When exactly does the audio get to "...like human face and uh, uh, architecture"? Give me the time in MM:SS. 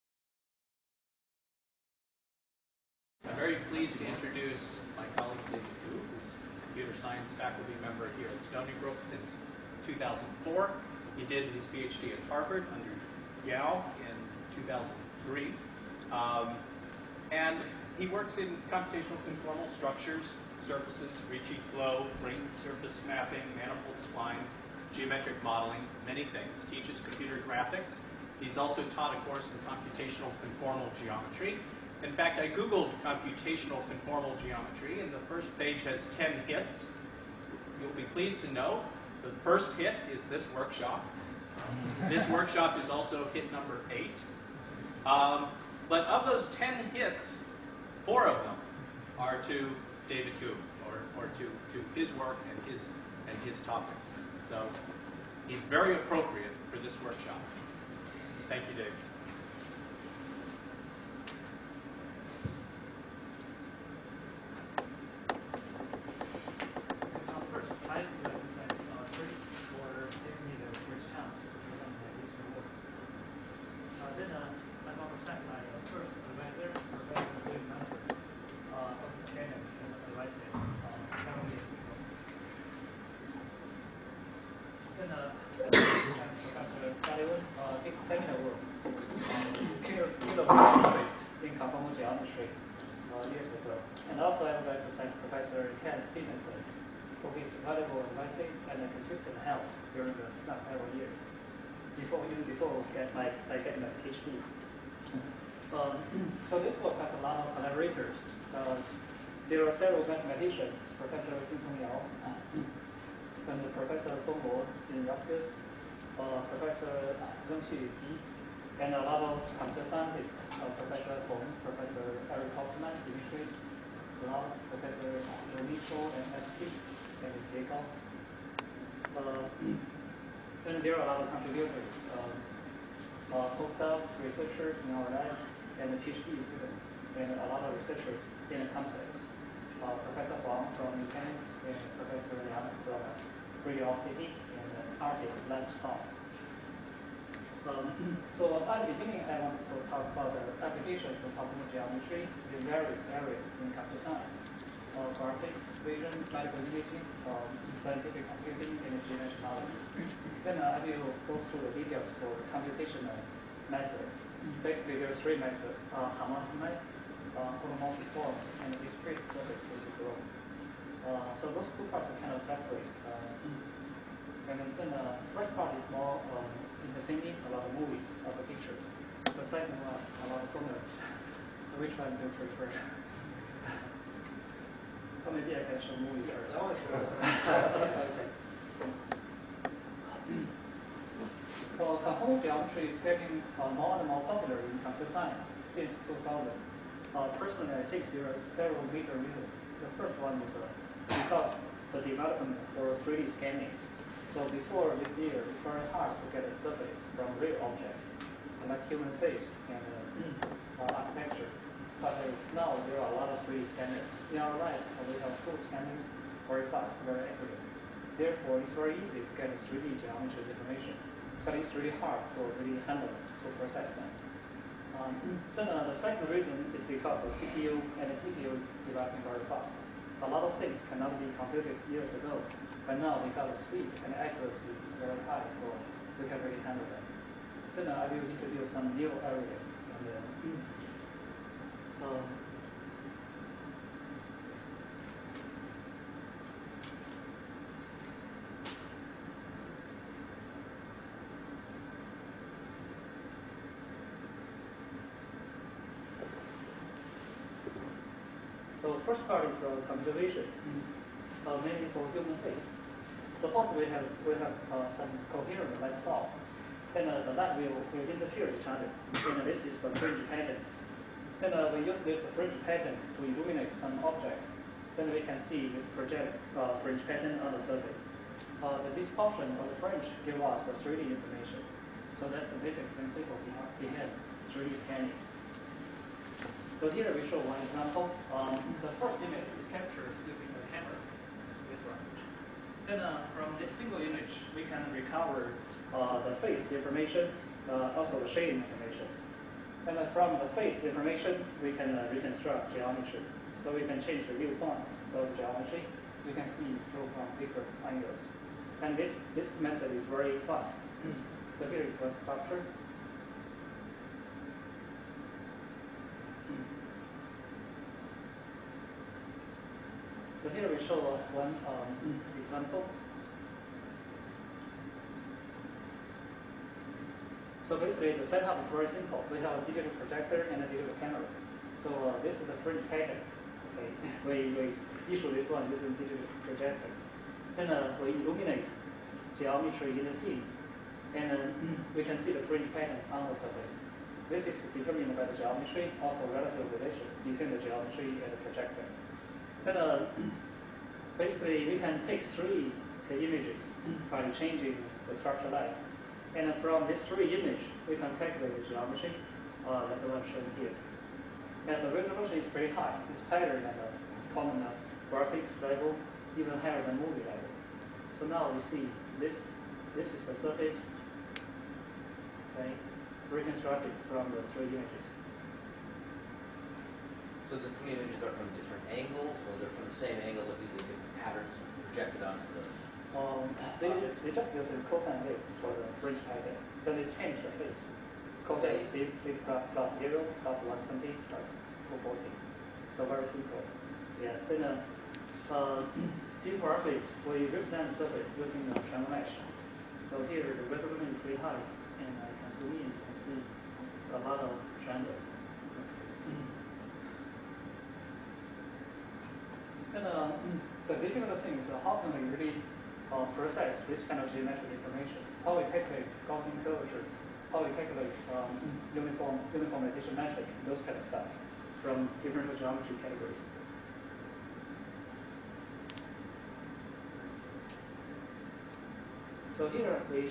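03:28.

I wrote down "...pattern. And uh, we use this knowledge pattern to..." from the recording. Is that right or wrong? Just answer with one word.
wrong.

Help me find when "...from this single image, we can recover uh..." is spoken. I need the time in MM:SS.
04:53.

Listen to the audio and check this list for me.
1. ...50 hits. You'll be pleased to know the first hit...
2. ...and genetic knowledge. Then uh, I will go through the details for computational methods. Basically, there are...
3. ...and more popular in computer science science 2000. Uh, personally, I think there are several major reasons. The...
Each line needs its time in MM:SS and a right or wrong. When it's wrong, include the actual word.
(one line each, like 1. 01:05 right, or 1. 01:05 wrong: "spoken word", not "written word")
1. 00:36 wrong: "10", not "50"
2. 02:38 right
3. 03:13 wrong: "since", not "science".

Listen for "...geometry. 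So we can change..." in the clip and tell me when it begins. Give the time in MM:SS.
05:02.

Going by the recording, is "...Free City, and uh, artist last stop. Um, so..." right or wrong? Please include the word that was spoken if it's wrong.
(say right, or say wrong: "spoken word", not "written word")
right.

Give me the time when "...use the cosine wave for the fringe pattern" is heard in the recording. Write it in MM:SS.
06:24.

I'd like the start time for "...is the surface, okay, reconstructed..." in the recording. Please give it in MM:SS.
06:10.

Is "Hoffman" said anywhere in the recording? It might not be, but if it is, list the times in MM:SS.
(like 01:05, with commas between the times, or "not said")
02:02.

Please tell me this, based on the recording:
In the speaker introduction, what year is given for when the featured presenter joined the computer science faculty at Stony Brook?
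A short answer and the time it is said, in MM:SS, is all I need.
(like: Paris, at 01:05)
2004, at 00:09.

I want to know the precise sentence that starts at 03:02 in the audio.
so maybe I can show movies first.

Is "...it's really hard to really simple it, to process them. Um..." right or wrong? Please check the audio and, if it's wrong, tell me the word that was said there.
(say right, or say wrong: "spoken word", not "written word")
wrong: "handle", not "simple".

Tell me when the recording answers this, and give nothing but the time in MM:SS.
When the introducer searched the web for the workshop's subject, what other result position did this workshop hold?
00:43.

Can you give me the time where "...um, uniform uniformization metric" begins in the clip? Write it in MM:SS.
06:58.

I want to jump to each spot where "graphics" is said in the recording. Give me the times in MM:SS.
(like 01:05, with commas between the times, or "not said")
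00:27, 02:35, 06:05, 06:36.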